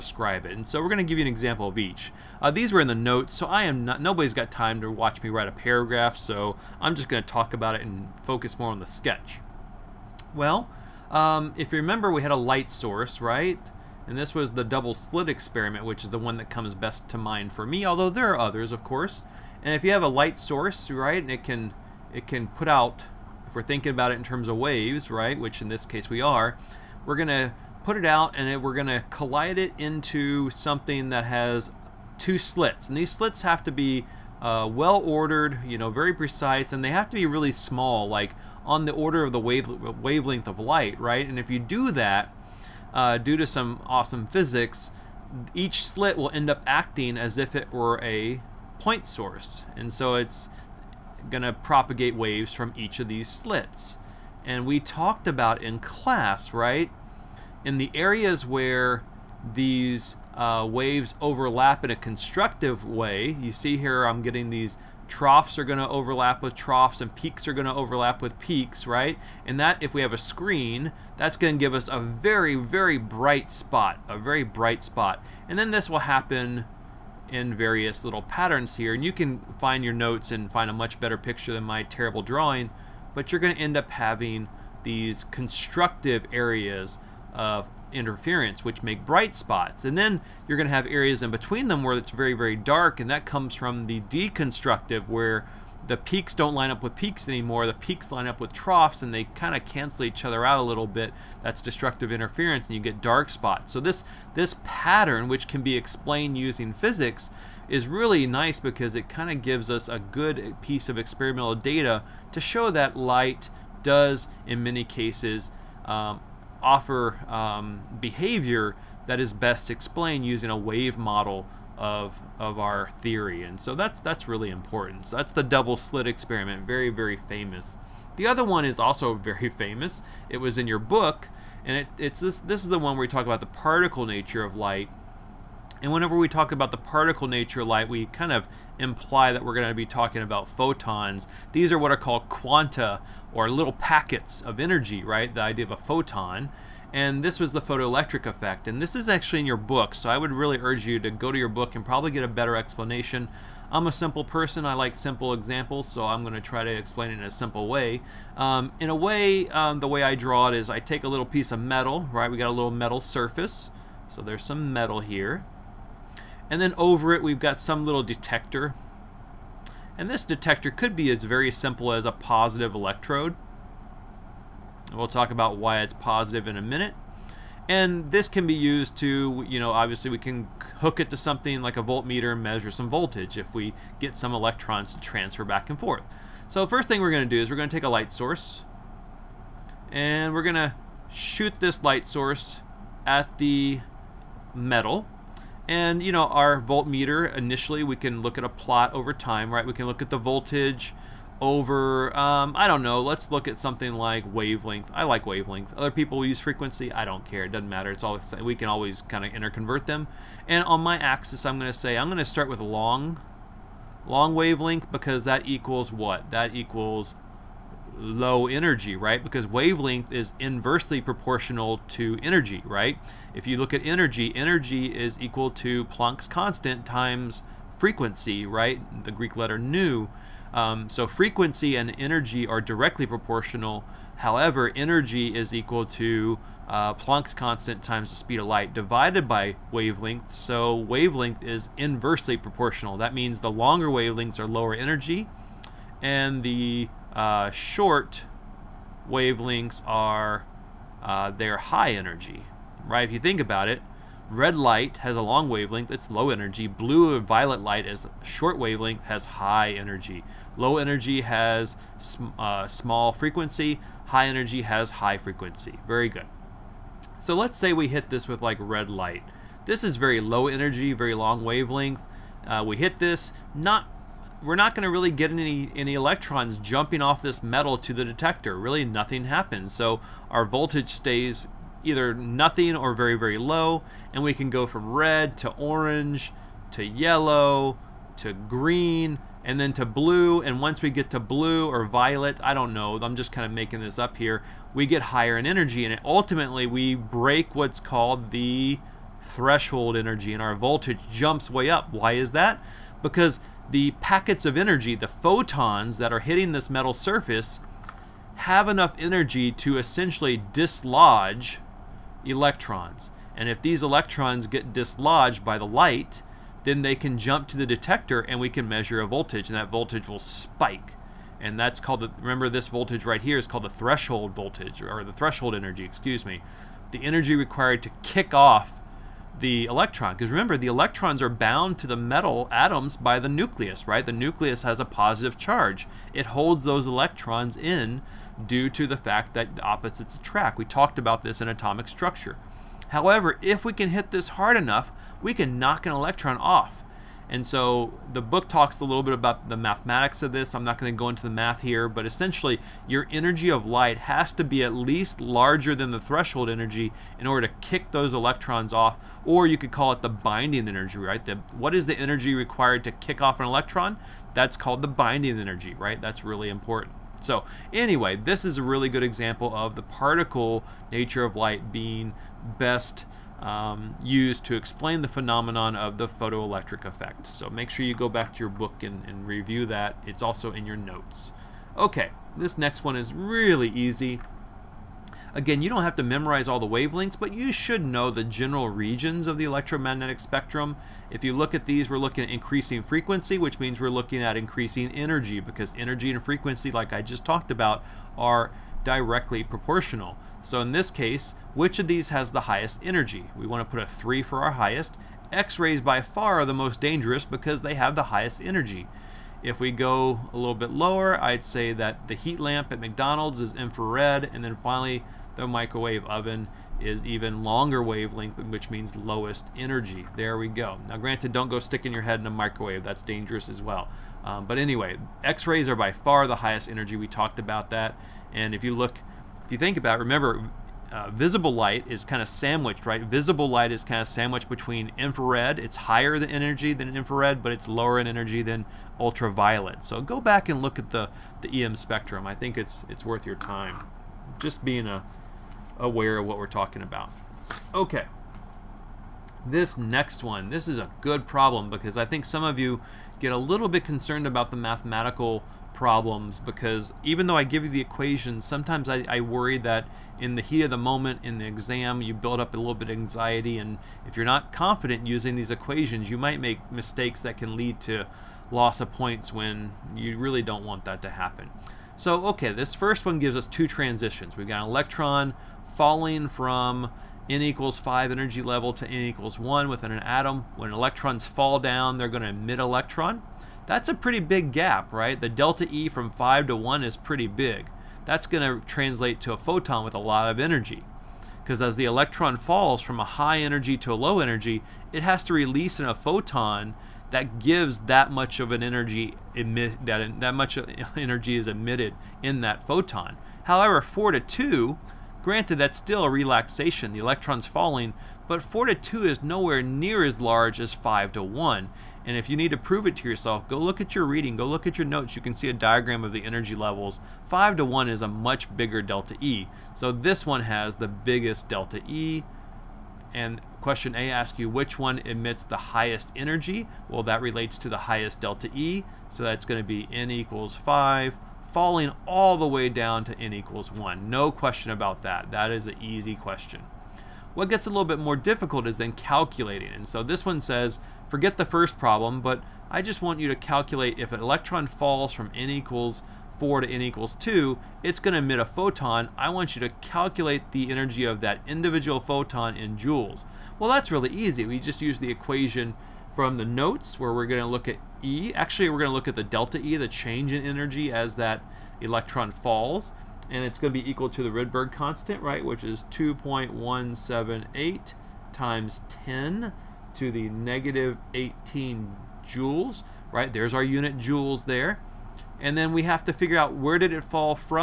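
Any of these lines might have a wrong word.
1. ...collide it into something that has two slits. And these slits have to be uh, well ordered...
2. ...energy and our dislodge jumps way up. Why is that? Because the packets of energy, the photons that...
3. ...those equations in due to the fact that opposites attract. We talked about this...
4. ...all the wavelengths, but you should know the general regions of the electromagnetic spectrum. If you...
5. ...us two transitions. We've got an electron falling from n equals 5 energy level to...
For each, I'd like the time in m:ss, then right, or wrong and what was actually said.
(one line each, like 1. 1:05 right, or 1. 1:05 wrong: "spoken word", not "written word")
1. 0:29 right
2. 4:59 wrong: "voltage", not "dislodge"
3. 5:36 wrong: "electrons", not "equations"
4. 6:26 right
5. 7:53 right.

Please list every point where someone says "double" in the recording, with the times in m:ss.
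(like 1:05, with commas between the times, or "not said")
0:14, 2:05.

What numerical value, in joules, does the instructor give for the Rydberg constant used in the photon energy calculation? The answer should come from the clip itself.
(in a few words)
2.178 x 10^-18.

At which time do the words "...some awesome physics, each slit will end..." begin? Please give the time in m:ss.
0:43.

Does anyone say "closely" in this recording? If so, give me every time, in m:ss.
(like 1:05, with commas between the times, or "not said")
not said.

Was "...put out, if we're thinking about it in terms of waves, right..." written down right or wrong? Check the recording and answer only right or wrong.
right.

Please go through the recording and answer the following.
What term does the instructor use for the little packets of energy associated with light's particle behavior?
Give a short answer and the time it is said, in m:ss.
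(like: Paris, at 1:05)
quanta, at 2:22.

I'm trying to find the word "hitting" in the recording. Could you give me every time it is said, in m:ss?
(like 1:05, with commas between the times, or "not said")
5:06.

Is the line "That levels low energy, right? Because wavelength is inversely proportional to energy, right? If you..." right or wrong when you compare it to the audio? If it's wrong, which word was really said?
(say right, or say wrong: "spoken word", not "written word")
wrong: "equals", not "levels".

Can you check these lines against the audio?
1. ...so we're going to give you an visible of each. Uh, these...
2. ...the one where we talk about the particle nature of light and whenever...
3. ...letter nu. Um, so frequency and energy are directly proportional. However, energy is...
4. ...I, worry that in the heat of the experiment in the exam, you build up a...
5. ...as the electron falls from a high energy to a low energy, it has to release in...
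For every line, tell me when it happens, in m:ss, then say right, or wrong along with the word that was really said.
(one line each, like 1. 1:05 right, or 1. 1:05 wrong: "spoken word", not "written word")
1. 0:00 wrong: "example", not "visible"
2. 2:12 right
3. 3:49 right
4. 7:39 wrong: "moment", not "experiment"
5. 8:11 right.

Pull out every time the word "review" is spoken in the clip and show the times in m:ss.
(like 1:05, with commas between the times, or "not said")
6:19.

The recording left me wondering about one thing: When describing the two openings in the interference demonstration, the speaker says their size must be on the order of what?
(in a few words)
wavelength of light.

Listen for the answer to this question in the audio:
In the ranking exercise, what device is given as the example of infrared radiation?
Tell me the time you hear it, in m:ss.
6:52.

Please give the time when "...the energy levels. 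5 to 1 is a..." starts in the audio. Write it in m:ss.
8:36.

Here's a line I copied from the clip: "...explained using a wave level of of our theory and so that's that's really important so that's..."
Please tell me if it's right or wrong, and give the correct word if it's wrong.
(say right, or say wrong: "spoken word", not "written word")
wrong: "model", not "level".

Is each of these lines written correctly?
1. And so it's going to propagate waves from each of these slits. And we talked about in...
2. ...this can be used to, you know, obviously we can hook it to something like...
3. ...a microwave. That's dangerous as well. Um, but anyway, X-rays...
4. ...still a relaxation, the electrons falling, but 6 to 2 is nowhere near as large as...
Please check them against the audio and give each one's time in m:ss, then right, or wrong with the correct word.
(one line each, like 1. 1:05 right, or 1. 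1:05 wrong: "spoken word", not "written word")
1. 0:49 right
2. 2:58 right
3. 7:02 right
4. 8:25 wrong: "4", not "6".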